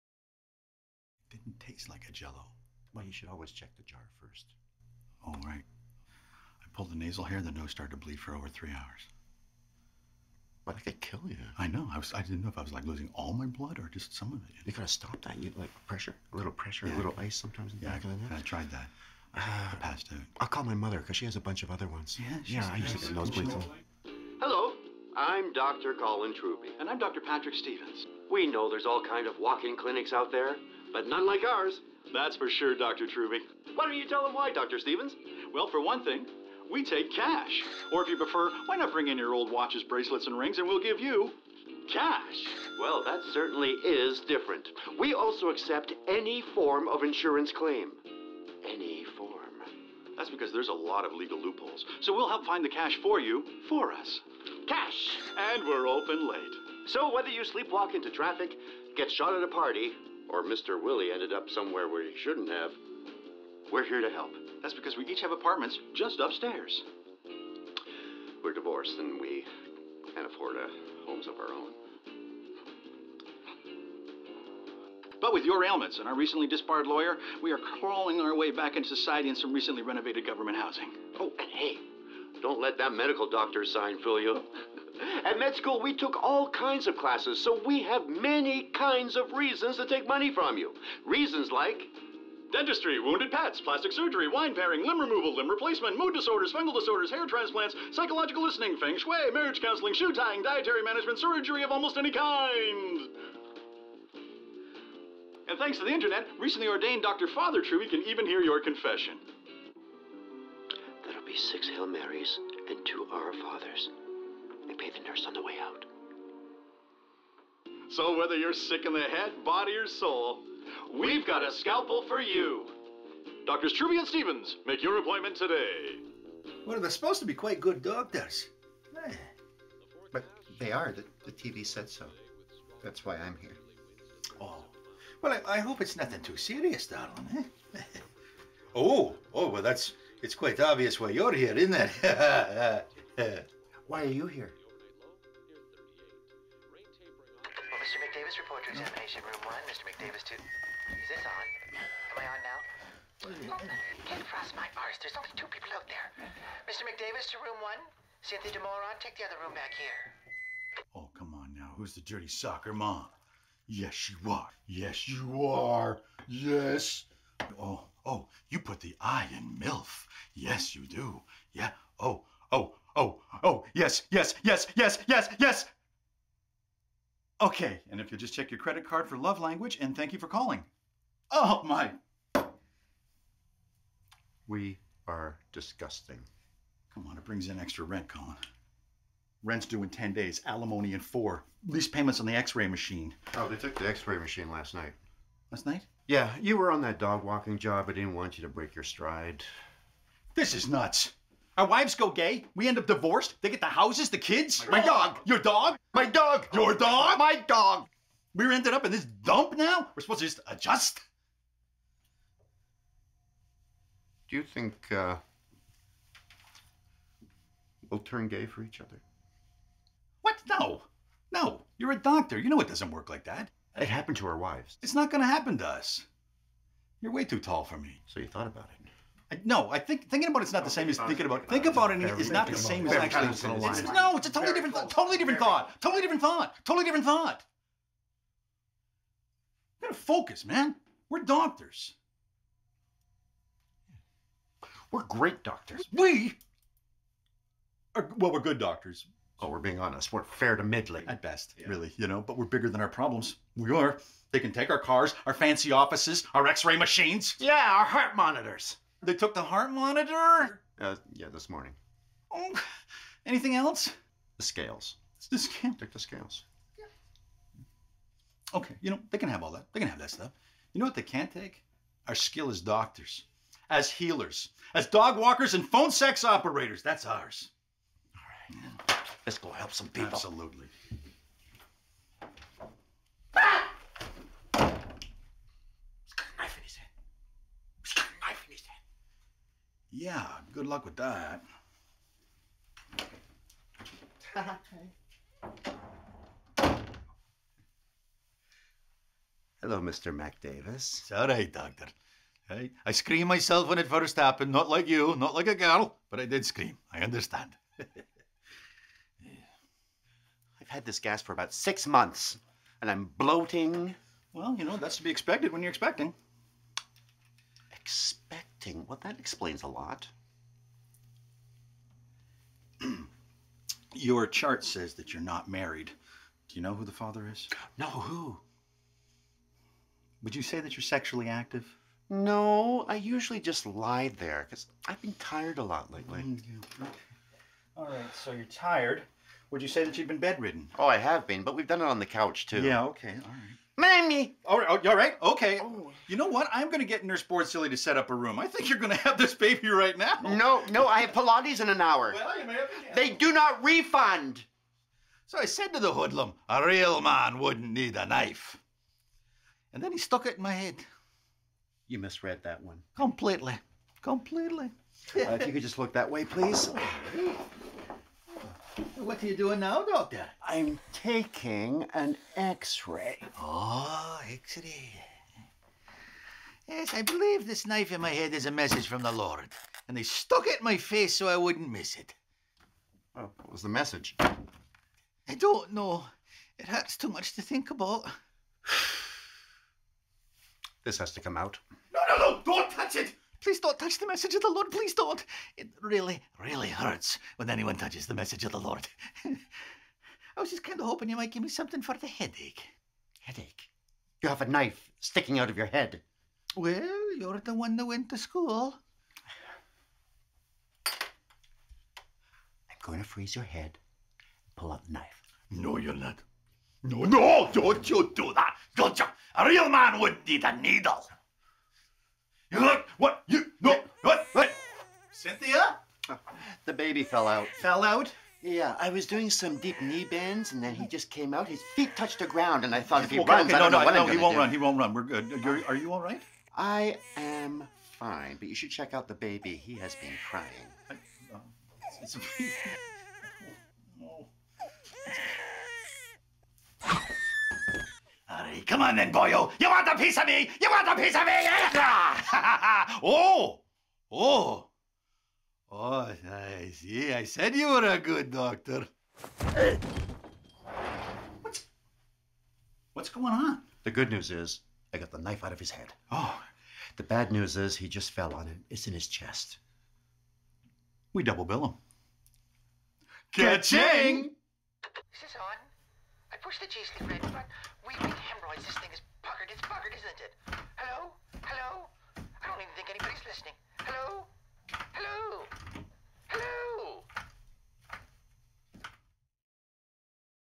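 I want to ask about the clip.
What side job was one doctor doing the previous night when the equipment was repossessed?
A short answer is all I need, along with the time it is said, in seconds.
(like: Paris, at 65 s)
Dog walking, at 196 s.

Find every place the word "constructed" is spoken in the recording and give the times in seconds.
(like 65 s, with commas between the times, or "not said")
not said.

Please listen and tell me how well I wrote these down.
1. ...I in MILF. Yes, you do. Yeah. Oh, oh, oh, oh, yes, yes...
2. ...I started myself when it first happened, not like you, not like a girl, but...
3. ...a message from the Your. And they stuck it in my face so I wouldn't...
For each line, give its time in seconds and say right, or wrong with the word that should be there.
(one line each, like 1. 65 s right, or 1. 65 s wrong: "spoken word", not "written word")
1. 169 s right
2. 302 s wrong: "screamed", not "started"
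3. 378 s wrong: "Lord", not "Your".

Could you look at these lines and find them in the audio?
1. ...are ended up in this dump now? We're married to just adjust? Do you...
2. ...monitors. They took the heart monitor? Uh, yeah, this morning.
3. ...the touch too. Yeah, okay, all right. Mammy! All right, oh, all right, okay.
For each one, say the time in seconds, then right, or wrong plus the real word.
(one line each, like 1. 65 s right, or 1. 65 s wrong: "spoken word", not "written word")
1. 208 s wrong: "supposed", not "married"
2. 258 s right
3. 341 s wrong: "couch", not "touch".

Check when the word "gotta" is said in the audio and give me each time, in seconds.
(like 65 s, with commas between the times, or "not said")
14 s, 239 s.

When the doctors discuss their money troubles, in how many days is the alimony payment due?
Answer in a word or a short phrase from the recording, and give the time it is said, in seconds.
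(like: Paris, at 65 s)
4, at 190 s.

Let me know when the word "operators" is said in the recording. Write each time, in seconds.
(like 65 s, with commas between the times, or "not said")
276 s.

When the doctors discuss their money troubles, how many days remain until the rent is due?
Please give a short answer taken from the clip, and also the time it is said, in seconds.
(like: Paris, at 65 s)
10, at 189 s.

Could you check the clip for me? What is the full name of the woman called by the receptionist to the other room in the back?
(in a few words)
Cynthia DeMoron.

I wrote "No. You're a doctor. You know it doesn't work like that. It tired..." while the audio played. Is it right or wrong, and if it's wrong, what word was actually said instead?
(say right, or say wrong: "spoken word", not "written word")
wrong: "happened", not "tired".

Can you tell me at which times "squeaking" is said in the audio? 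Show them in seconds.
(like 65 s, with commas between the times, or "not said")
not said.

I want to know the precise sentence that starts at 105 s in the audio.
And thanks to the internet, recently ordained Dr.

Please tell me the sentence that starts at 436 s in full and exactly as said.
I am fine, but you should check out the baby.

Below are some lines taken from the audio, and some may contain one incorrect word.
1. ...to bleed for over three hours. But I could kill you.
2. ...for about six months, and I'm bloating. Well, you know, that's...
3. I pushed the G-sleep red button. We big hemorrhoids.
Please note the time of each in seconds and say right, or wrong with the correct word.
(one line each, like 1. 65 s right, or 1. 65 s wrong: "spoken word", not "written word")
1. 7 s right
2. 311 s right
3. 476 s right.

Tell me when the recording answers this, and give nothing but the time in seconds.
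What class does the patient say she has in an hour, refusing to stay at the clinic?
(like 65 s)
351 s.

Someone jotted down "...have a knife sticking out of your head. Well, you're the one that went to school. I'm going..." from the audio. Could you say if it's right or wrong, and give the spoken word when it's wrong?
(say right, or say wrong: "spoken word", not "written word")
right.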